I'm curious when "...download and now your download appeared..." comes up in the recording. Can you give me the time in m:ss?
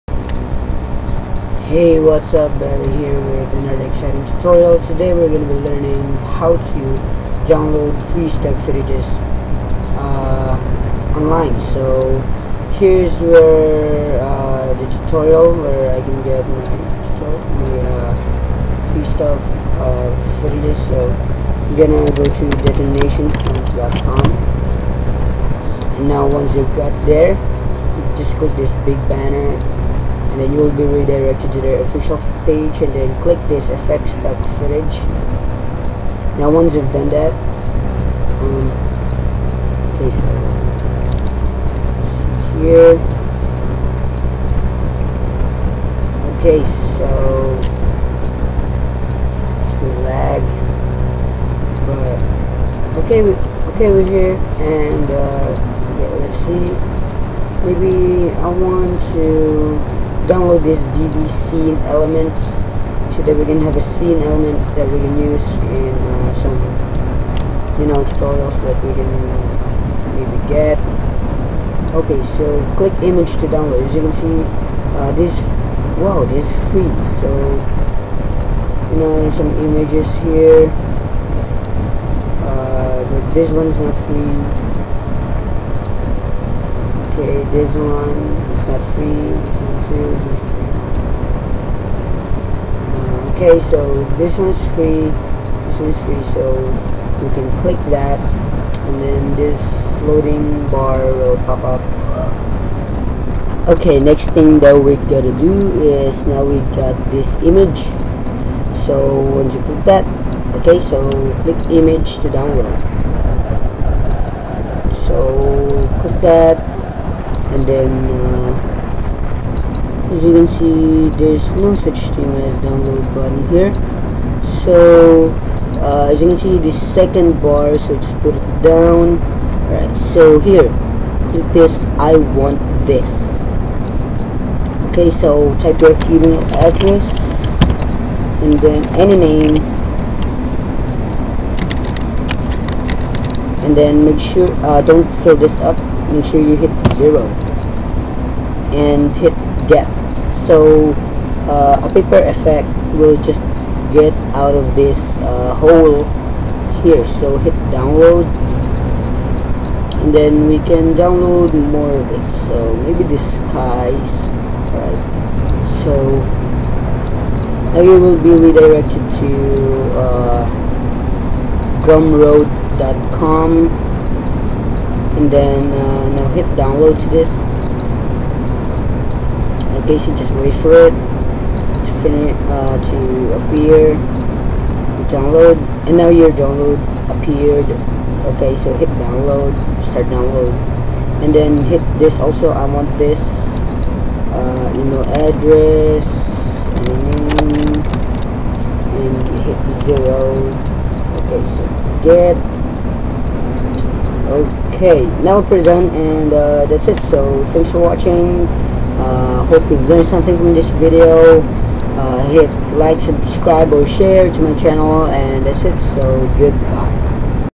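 3:05.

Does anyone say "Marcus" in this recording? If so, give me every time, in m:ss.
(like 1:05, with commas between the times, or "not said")
not said.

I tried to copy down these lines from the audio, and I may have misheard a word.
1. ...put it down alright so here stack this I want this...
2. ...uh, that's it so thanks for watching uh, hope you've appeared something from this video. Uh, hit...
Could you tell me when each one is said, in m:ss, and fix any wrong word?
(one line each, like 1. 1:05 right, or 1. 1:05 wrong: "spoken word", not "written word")
1. 2:08 wrong: "click", not "stack"
2. 3:26 wrong: "learned", not "appeared".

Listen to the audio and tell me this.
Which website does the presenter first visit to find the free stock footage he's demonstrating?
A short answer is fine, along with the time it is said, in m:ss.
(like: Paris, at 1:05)
detonationfilms.com, at 0:22.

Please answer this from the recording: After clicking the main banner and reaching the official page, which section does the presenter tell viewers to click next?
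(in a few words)
effects stock footage.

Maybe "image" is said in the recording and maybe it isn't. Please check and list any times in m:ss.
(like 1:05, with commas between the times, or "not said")
1:13, 1:19, 1:47, 1:51.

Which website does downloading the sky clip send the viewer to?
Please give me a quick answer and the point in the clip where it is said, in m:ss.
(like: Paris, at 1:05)
gumroad.com, at 2:51.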